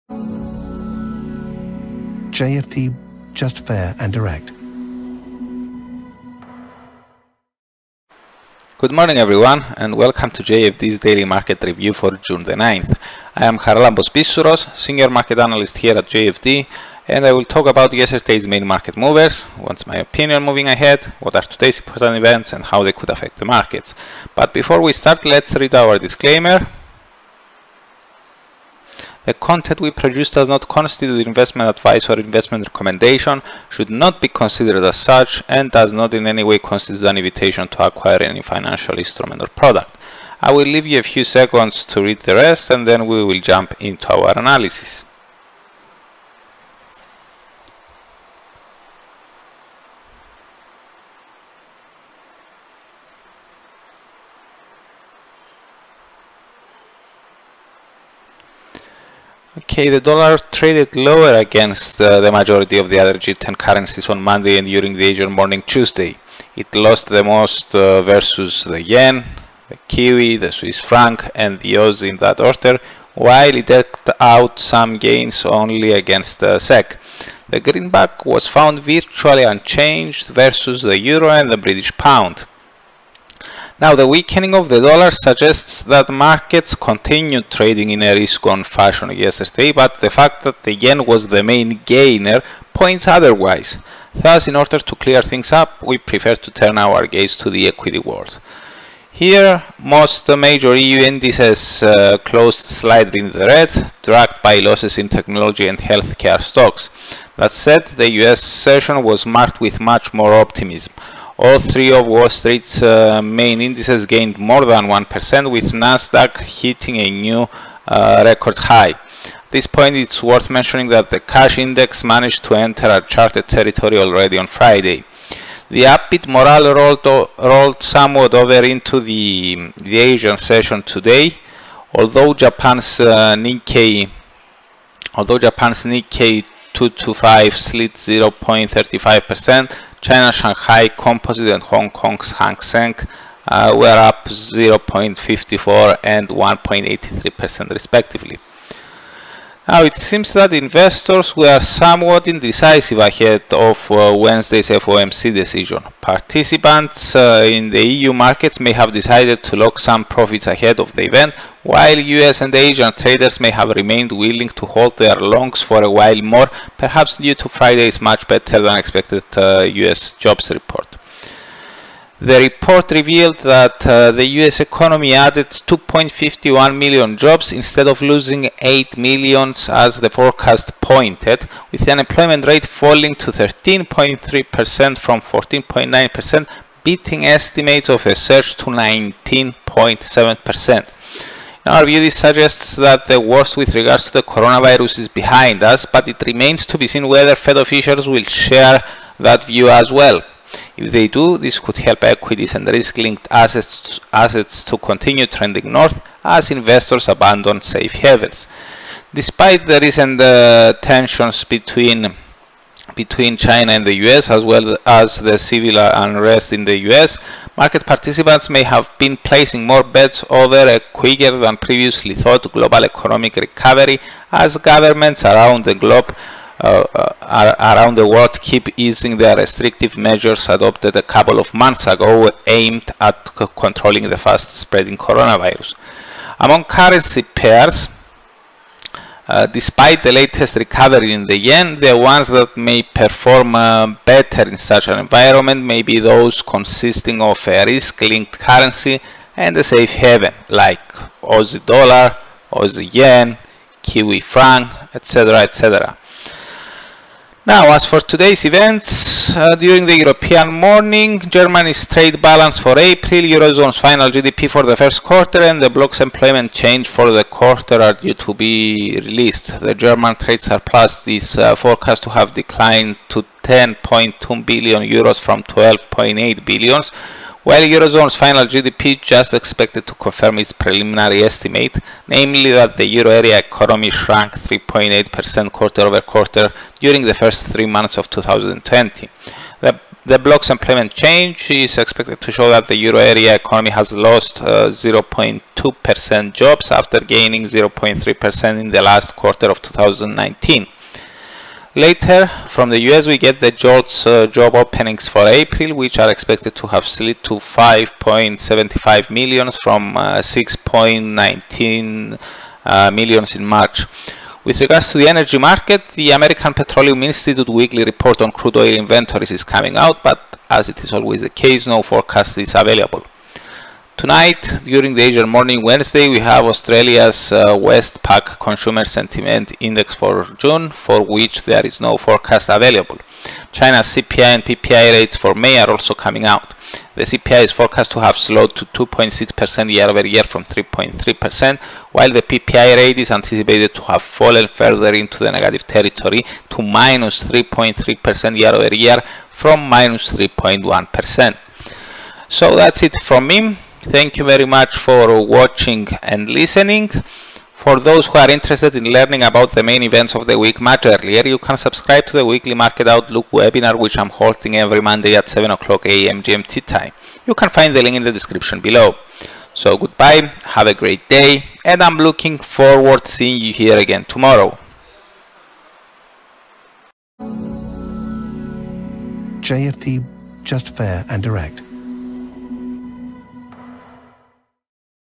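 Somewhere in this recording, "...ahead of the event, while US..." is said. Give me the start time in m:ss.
2:40.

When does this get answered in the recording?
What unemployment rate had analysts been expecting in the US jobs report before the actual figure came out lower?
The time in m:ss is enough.
3:08.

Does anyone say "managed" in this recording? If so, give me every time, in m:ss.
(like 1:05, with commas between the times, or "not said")
2:02.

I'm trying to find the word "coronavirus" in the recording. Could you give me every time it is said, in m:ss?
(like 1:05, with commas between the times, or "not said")
3:14, 3:54.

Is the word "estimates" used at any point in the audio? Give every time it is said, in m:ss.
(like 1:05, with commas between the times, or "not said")
3:07, 4:41.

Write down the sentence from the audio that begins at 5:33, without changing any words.
China's CPI and PPI rates for May are also coming out.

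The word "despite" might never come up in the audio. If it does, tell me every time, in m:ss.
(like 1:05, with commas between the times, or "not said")
3:29, 3:59.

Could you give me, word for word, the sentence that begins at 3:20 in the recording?
If they do, this could help equities and risk-linked assets, assets to continue trending north as investors abandon safe havens.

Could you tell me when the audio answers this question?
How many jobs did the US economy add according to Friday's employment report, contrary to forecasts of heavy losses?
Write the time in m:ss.
2:55.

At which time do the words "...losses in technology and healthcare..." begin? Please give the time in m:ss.
1:44.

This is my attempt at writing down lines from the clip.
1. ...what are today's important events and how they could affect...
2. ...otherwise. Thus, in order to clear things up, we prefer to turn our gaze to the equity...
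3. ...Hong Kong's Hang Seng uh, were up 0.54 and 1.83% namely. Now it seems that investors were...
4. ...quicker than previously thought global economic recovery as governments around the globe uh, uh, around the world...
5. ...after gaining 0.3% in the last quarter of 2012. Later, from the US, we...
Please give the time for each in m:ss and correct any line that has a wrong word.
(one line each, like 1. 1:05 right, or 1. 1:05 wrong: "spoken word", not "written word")
1. 0:21 right
2. 1:33 right
3. 2:21 wrong: "respectively", not "namely"
4. 3:40 right
5. 4:56 wrong: "2019", not "2012".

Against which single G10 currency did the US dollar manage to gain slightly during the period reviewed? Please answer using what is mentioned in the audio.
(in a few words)
SEK.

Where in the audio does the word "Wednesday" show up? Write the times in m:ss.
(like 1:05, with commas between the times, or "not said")
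2:34, 5:25.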